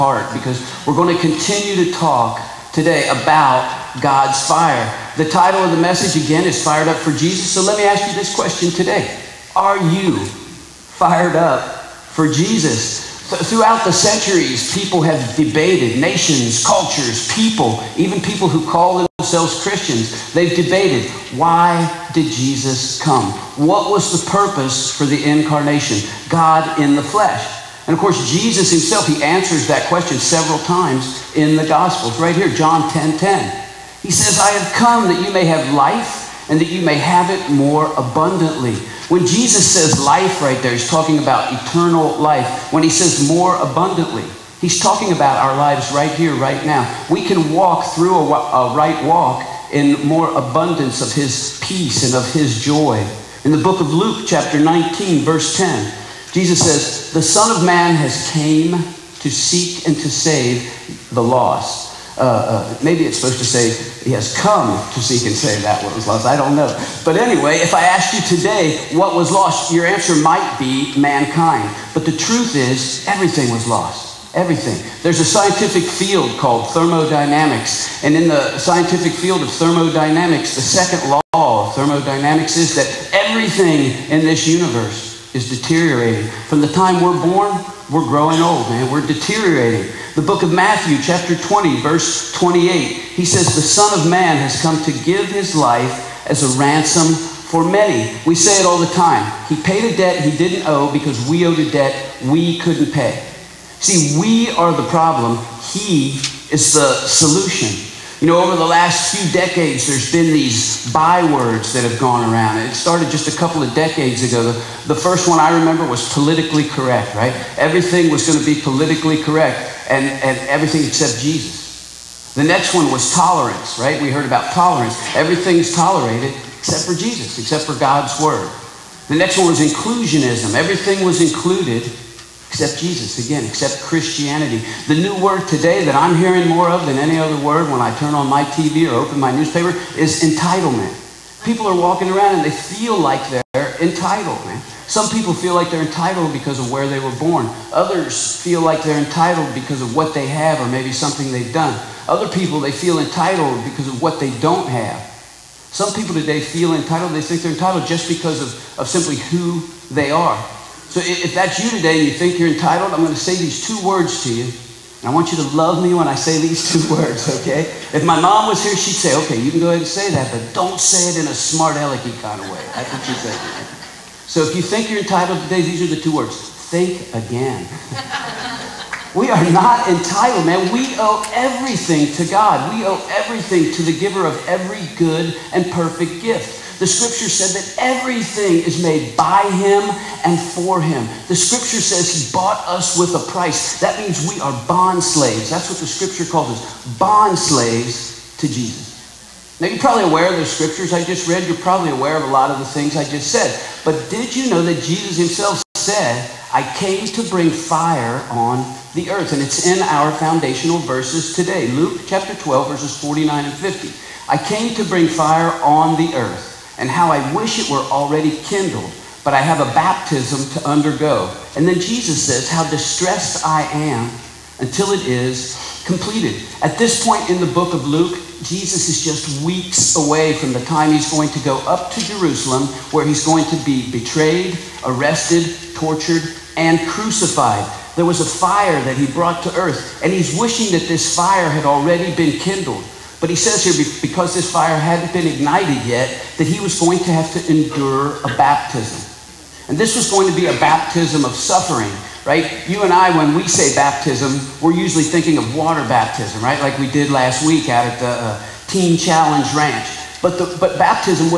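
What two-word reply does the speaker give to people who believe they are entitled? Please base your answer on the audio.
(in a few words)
Think again.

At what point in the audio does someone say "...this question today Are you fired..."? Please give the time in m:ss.
0:08.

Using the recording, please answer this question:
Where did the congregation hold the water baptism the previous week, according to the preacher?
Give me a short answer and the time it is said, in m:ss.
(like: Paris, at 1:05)
Teen Challenge Ranch, at 4:18.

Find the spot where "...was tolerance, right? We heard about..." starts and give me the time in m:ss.
2:02.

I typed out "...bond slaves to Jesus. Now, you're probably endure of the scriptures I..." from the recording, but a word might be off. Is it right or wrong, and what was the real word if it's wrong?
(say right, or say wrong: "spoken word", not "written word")
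wrong: "aware", not "endure".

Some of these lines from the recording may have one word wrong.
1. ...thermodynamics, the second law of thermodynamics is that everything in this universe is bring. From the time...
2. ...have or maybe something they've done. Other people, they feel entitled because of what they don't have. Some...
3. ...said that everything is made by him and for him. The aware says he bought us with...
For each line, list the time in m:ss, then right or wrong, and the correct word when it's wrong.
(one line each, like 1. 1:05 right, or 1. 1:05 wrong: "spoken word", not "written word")
1. 1:19 wrong: "deteriorating", not "bring"
2. 2:30 right
3. 3:07 wrong: "scripture", not "aware".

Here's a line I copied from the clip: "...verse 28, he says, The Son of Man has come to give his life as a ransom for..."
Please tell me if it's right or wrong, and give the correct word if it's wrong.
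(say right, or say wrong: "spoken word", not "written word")
right.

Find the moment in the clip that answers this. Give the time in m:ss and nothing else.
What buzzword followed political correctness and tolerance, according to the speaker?
2:09.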